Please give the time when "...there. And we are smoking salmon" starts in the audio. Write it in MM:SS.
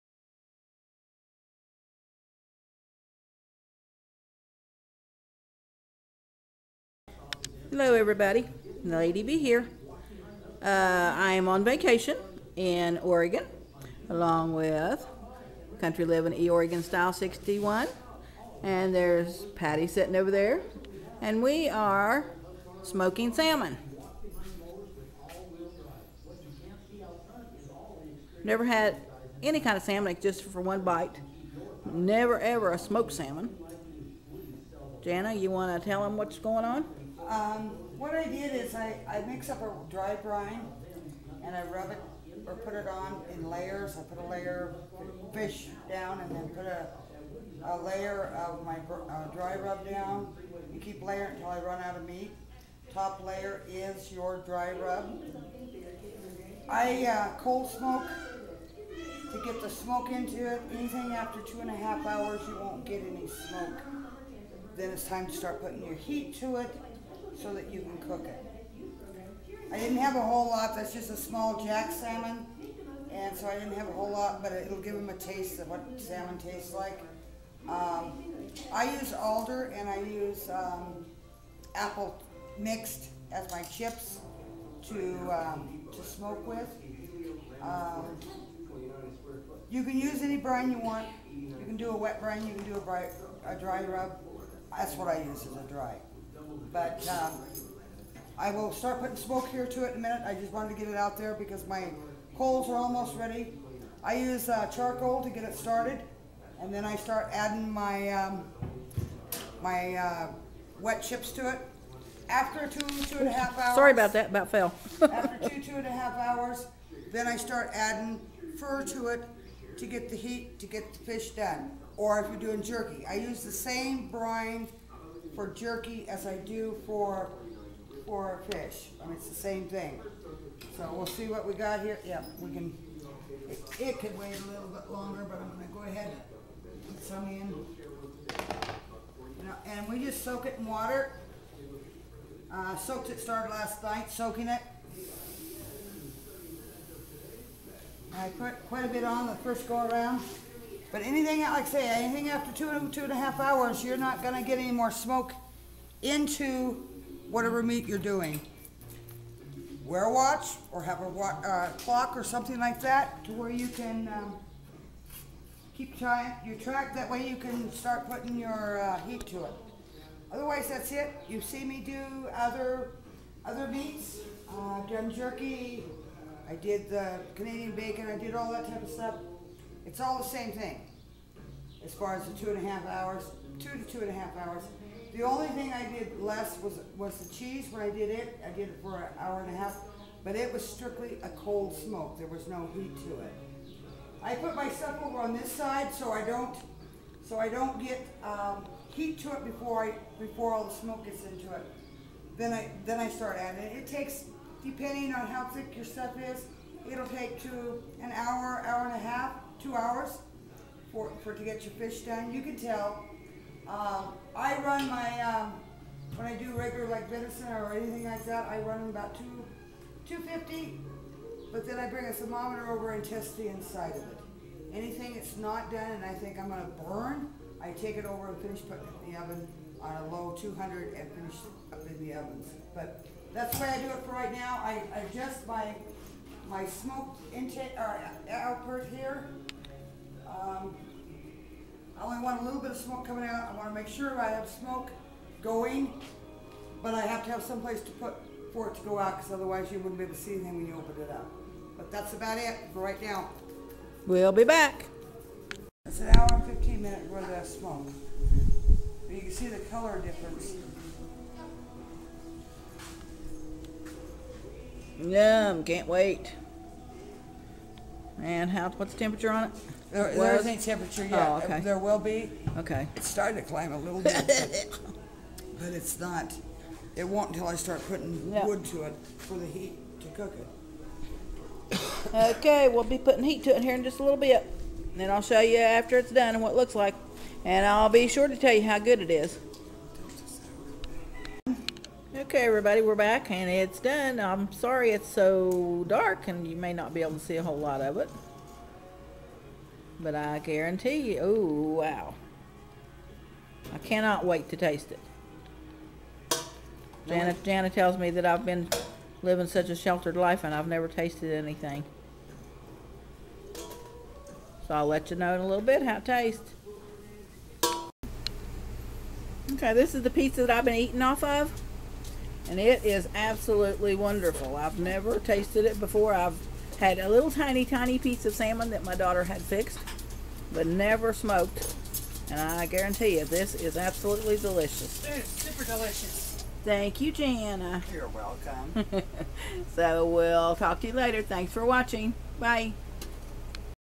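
00:20.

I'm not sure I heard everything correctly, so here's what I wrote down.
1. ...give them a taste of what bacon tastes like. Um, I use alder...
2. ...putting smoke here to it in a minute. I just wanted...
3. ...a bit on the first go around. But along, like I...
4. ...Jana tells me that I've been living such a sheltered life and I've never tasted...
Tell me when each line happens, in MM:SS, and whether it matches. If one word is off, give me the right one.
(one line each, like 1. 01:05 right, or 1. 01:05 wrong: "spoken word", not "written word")
1. 01:14 wrong: "salmon", not "bacon"
2. 01:39 right
3. 02:28 wrong: "anything", not "along"
4. 05:07 right.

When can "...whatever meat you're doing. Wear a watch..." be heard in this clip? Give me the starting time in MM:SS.
02:37.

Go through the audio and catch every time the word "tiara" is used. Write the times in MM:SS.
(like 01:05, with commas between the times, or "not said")
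not said.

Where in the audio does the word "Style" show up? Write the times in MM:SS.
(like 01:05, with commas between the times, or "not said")
00:16.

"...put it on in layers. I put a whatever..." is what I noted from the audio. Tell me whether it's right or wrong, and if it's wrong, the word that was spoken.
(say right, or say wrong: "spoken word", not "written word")
wrong: "layer", not "whatever".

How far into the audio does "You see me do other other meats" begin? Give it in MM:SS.
02:51.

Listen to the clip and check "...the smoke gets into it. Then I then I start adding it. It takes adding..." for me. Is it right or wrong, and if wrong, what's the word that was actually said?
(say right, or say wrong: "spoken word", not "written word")
wrong: "depending", not "adding".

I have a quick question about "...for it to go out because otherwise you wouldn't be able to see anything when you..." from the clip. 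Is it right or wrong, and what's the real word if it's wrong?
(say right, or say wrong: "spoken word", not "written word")
right.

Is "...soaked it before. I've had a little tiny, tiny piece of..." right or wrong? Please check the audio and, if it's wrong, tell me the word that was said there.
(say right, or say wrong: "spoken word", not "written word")
wrong: "tasted", not "soaked".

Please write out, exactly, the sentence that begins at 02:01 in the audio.
Or if you're doing jerky, I use the same brine for jerky as I do for for fish.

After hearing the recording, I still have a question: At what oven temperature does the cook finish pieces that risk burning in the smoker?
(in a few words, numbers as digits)
200.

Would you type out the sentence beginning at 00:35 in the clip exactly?
Jana, you want to tell them what's going on?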